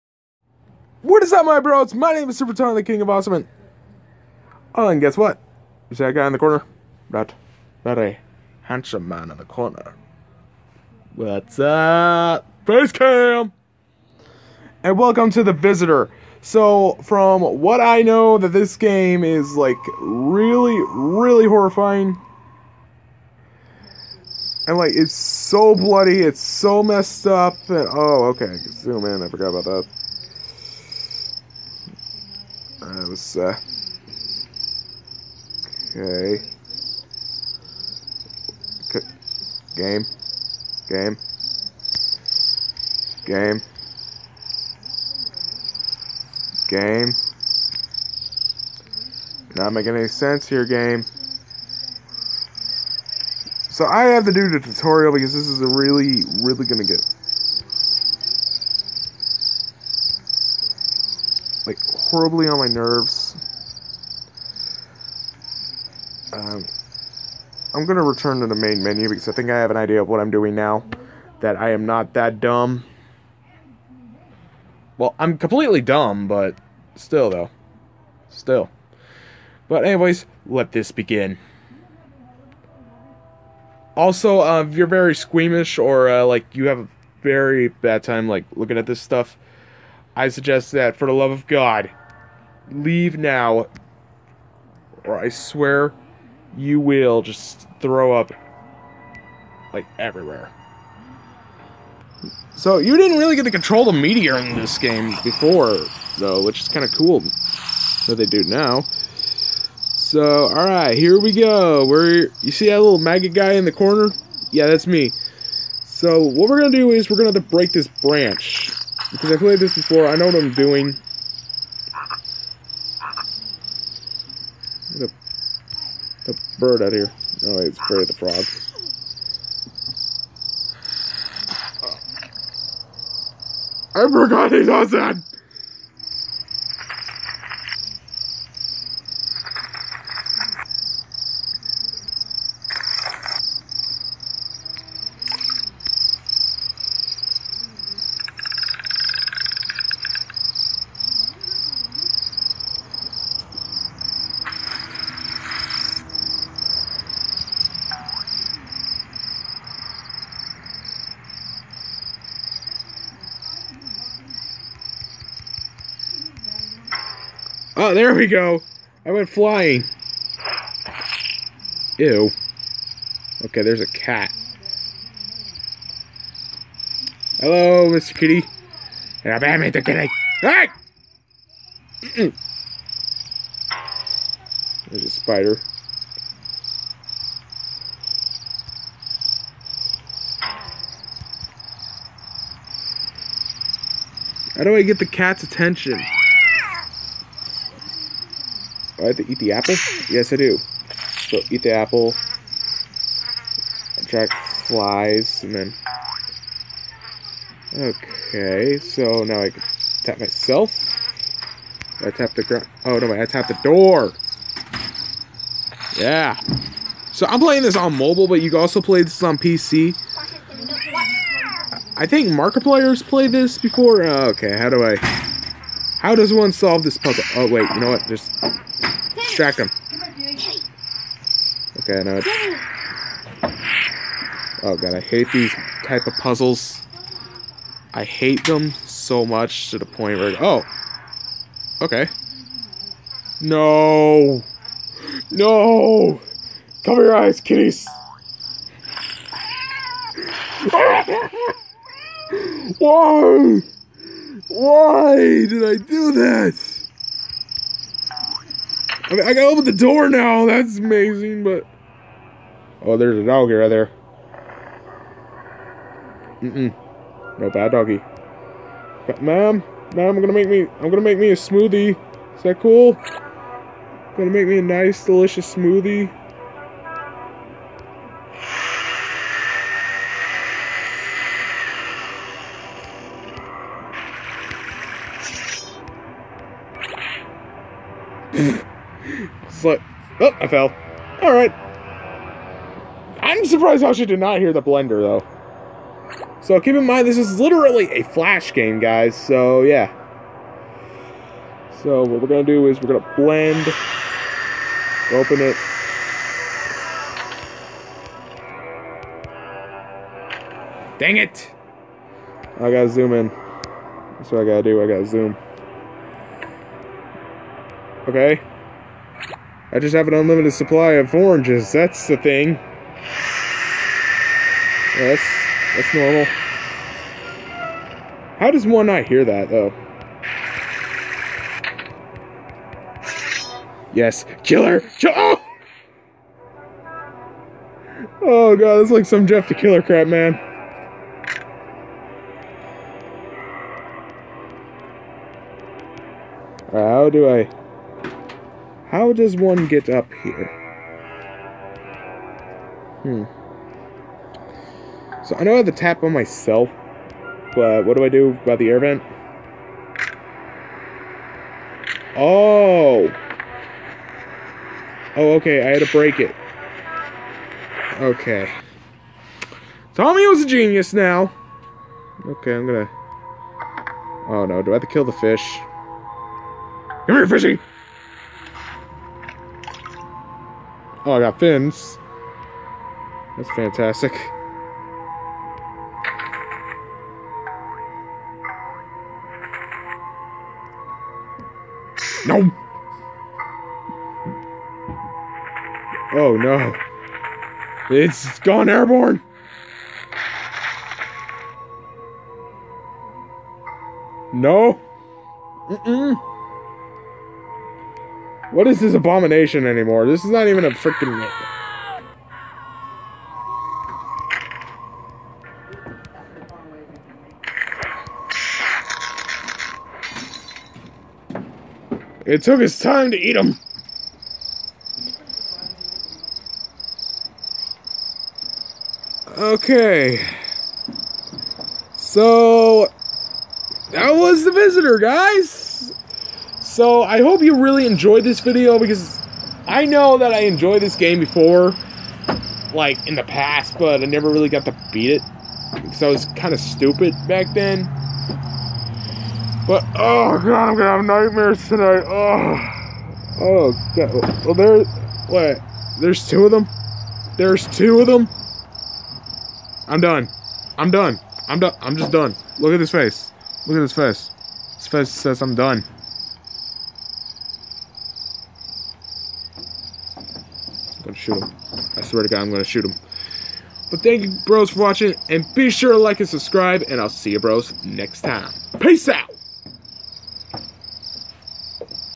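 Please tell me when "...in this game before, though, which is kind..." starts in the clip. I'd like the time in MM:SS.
01:44.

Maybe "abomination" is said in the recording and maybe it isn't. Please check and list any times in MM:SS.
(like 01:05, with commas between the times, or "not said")
06:48.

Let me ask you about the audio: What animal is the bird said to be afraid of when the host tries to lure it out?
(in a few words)
Frog.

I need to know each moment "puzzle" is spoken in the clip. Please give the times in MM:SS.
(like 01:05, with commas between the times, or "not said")
03:46, 03:56.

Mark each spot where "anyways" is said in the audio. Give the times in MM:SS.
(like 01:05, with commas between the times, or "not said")
01:19.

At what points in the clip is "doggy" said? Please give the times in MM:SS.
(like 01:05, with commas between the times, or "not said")
04:23, 04:27.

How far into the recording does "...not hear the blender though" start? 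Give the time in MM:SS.
04:54.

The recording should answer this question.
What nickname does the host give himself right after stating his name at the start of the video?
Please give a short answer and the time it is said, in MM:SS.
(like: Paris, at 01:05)
King of Awesome, at 00:02.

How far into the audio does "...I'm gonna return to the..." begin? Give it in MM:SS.
01:07.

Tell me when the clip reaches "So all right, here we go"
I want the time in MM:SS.
01:49.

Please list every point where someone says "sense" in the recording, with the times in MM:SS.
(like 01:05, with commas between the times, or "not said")
00:50.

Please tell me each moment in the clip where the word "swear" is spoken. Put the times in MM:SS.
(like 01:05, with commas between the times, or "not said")
01:35, 07:52.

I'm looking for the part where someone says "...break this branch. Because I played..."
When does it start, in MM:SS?
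01:57.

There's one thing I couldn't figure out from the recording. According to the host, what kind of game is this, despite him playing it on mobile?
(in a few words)
Flash game.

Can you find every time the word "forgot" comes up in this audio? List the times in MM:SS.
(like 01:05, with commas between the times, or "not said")
00:29, 02:14.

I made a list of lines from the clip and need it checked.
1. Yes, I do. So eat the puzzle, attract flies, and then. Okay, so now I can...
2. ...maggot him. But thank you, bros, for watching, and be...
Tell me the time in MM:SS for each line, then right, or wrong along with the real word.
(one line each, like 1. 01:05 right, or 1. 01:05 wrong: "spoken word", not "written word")
1. 03:20 wrong: "apple", not "puzzle"
2. 07:52 wrong: "shoot", not "maggot".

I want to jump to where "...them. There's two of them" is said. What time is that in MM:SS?
07:36.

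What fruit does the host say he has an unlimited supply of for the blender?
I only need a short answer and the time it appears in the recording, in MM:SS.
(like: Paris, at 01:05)
Oranges, at 05:21.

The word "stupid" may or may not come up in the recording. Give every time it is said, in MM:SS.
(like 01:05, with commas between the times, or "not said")
07:26.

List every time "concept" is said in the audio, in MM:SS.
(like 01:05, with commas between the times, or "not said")
not said.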